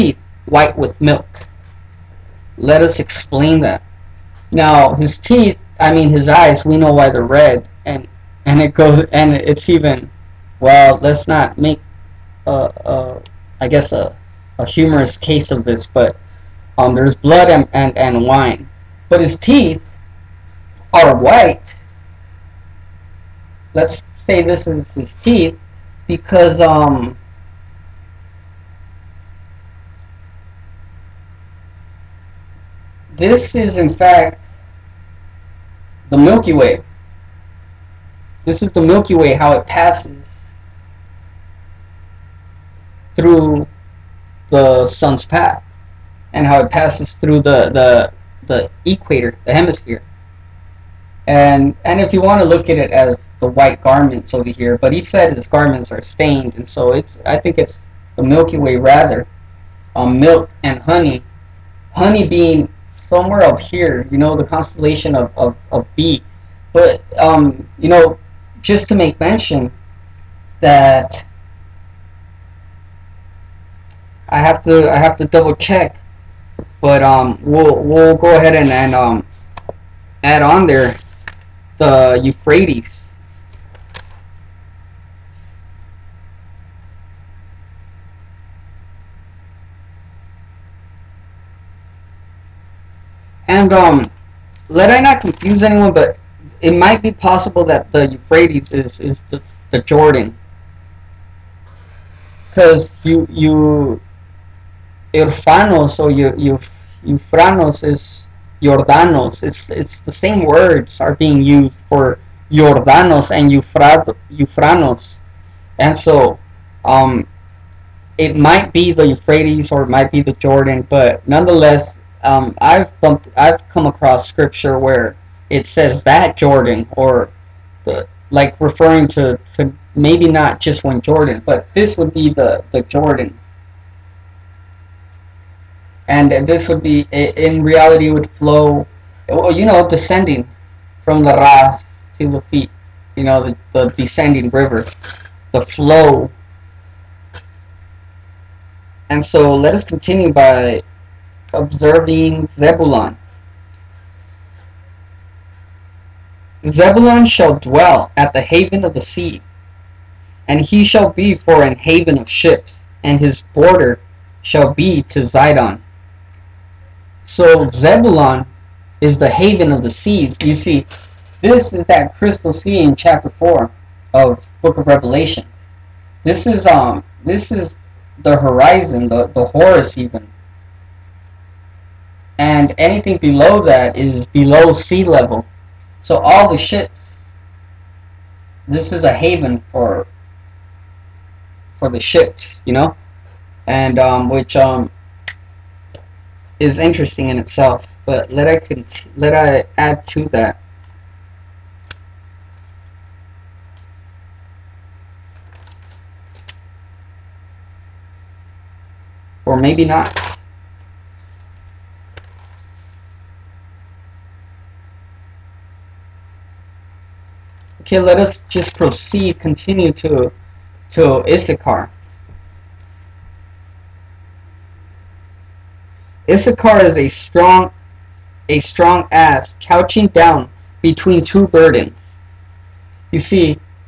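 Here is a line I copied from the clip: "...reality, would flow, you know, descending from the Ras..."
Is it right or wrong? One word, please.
right.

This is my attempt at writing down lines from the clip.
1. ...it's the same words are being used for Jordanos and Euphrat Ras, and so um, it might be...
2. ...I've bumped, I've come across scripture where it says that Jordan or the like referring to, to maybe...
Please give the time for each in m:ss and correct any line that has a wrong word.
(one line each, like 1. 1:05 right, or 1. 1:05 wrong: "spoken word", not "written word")
1. 1:49 wrong: "Euphranos", not "Ras"
2. 2:02 right.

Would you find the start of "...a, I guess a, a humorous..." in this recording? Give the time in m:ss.
0:12.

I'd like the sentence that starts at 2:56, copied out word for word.
This is um this is the horizon, the, the Horus even, and anything below that is below sea level.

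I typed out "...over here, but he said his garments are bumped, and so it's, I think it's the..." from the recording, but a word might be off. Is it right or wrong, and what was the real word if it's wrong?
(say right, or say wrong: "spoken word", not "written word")
wrong: "stained", not "bumped".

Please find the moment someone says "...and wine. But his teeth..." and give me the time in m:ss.
0:17.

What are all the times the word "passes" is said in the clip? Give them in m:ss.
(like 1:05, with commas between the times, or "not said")
0:39, 0:46.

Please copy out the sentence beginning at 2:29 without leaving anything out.
And so let us continue by observing Zebulun.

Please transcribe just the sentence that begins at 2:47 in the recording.
So Zebulun is the haven of the seas.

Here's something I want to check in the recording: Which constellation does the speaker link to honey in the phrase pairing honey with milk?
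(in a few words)
B.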